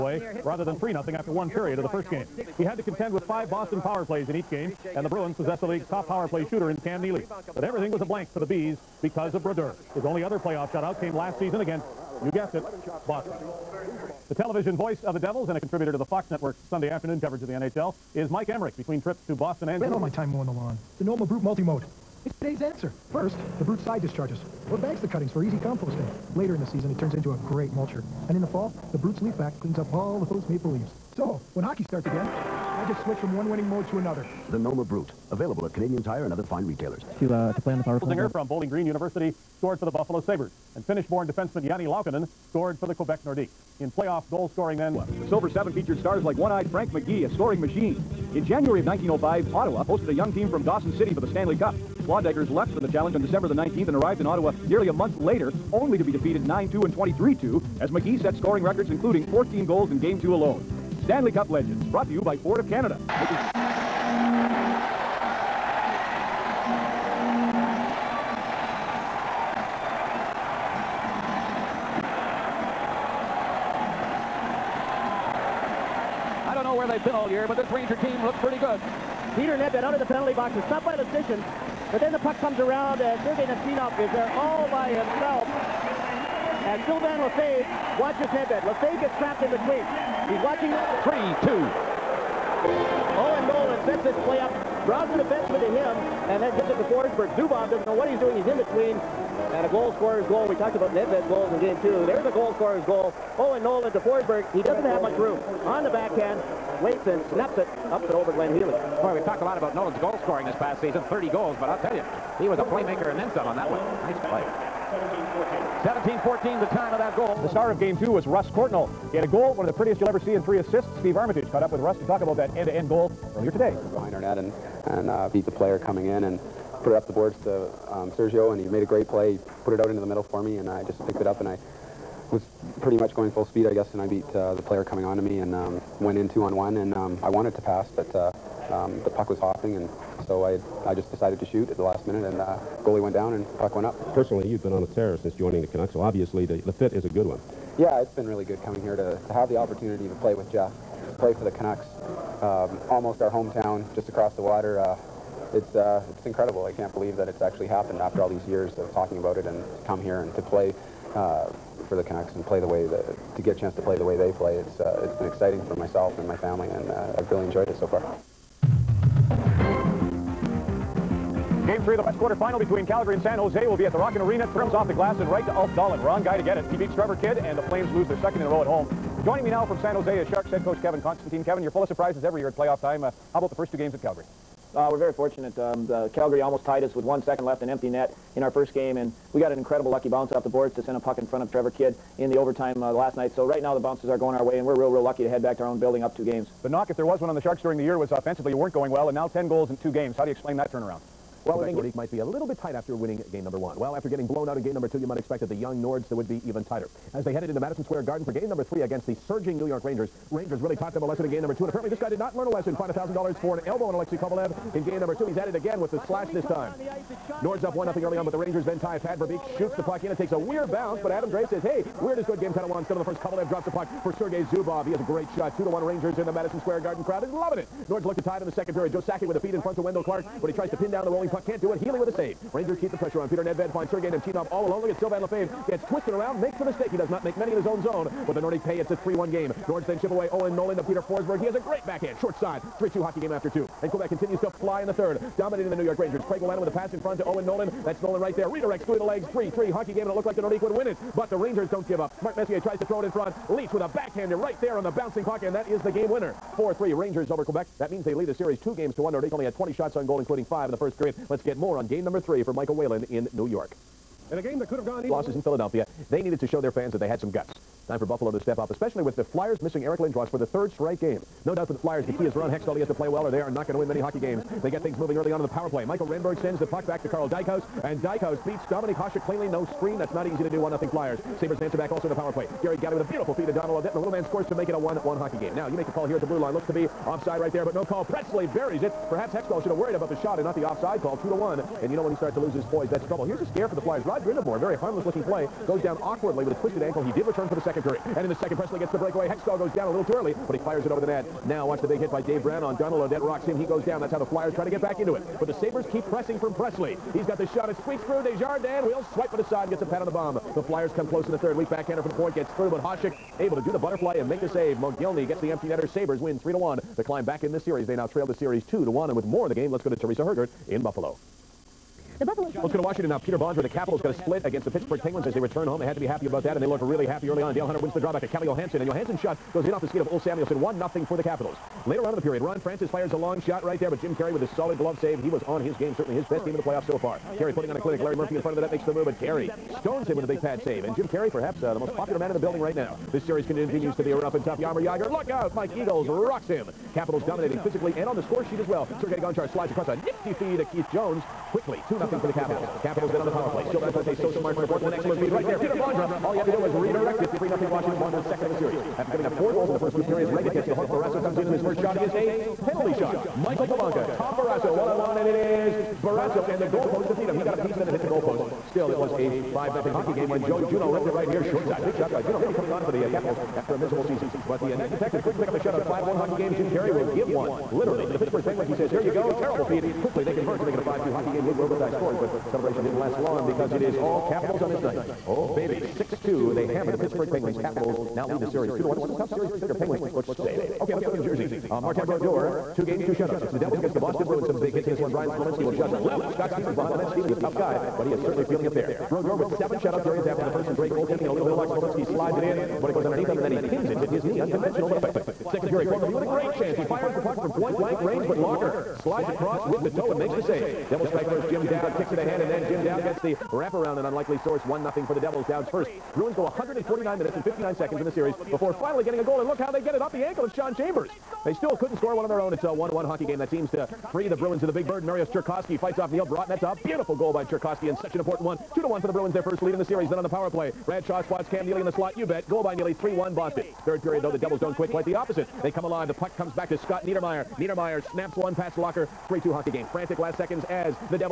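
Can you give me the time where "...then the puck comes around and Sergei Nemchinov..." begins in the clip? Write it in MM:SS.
01:21.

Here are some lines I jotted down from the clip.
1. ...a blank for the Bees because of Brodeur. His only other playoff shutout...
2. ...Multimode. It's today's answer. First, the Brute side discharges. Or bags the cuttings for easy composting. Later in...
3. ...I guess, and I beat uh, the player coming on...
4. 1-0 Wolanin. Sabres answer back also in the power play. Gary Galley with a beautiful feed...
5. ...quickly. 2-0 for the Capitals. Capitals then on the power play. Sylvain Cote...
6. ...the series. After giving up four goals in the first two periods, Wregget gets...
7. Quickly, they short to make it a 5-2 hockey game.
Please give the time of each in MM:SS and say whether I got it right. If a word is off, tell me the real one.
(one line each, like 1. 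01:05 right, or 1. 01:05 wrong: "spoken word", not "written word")
1. 00:08 right
2. 00:21 right
3. 02:13 right
4. 04:40 wrong: "Flyers", not "Wolanin"
5. 05:51 right
6. 05:58 right
7. 06:20 wrong: "convert", not "short".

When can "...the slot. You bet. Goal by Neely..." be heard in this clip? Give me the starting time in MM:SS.
07:11.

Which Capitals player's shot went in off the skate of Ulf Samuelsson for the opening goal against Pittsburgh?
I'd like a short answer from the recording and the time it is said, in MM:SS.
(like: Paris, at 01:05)
Calle Johansson, at 05:28.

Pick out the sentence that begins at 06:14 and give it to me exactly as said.
But the uh, next detective couldn't pick up the shutout 5-1 hockey game.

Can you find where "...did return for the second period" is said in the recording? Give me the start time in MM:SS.
04:57.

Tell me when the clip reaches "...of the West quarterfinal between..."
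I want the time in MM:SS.
02:51.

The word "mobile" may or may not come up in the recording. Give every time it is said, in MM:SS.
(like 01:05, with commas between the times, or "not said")
not said.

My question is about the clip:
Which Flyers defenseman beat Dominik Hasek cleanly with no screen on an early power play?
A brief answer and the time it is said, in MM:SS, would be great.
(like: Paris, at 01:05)
Karl Dykhuis, at 04:37.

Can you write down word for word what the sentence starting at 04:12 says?
Mark Messier tries to throw it in front.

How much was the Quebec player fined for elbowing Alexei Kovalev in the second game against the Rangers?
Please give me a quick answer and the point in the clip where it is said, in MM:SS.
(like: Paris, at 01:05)
$1,000, at 03:32.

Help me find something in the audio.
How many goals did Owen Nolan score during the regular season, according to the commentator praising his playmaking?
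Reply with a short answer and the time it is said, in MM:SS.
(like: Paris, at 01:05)
30, at 01:51.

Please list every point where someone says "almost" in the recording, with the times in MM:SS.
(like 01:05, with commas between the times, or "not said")
02:32, 03:06.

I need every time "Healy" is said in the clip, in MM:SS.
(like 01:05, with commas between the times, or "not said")
01:48, 03:51.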